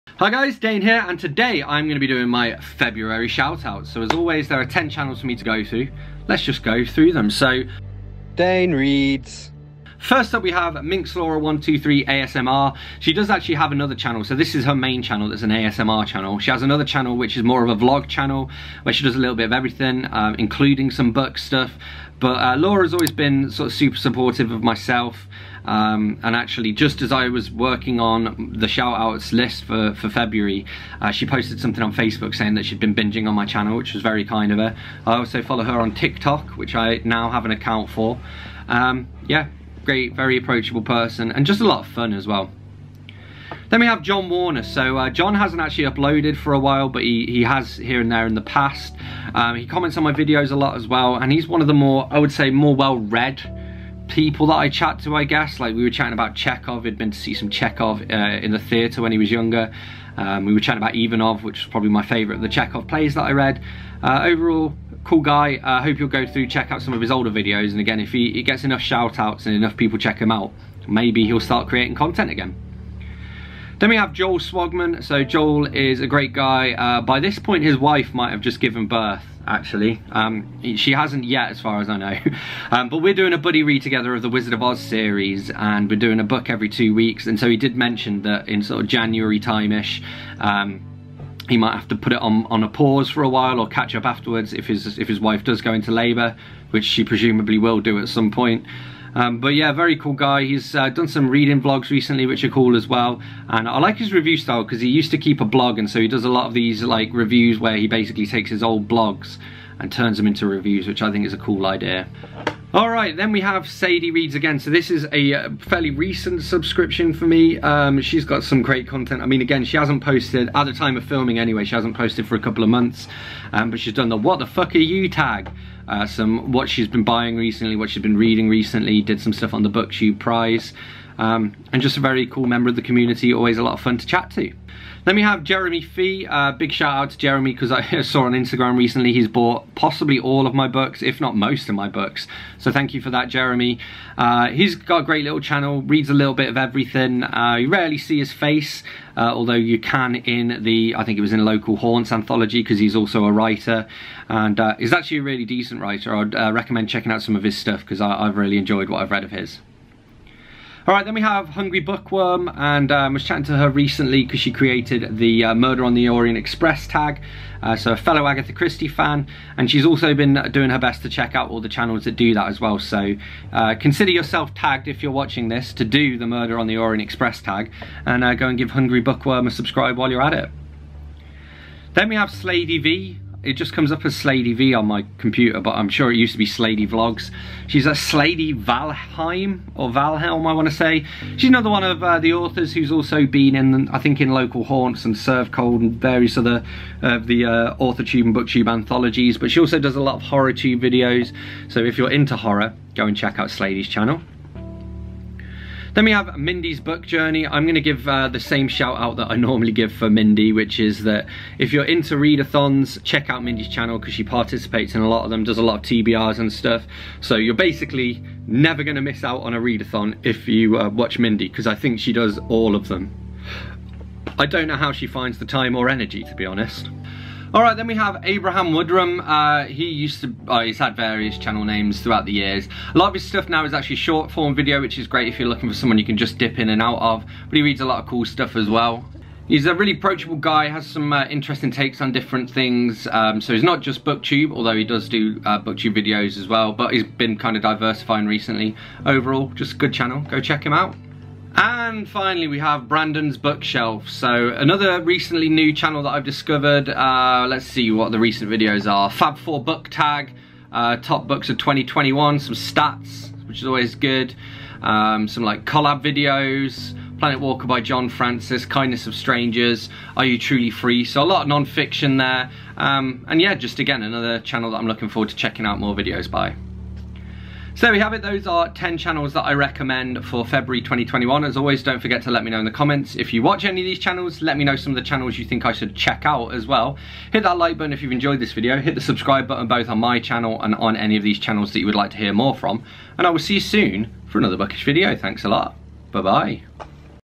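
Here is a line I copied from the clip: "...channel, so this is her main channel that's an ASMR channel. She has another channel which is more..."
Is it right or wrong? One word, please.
right.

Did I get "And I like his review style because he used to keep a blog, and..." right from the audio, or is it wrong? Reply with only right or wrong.
right.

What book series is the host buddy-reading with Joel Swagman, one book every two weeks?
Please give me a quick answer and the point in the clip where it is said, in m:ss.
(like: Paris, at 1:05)
The Wizard of Oz, at 1:24.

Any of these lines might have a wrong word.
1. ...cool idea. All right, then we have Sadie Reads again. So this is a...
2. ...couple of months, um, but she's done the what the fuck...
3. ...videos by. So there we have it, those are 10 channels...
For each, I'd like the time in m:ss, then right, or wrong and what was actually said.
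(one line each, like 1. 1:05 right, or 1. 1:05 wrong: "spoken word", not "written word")
1. 1:51 right
2. 2:02 right
3. 4:35 right.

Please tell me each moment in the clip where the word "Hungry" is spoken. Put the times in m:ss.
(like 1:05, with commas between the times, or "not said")
2:41, 2:58.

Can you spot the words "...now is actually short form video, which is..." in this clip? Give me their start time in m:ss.
3:53.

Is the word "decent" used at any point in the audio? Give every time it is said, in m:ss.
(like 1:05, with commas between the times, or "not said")
2:35.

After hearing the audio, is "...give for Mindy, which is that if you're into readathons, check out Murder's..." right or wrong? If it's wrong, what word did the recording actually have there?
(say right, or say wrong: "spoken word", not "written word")
wrong: "Mindy", not "Murder".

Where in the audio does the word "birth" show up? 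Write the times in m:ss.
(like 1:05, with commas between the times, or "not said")
1:18.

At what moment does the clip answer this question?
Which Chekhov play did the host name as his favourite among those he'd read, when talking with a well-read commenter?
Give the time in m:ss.
1:00.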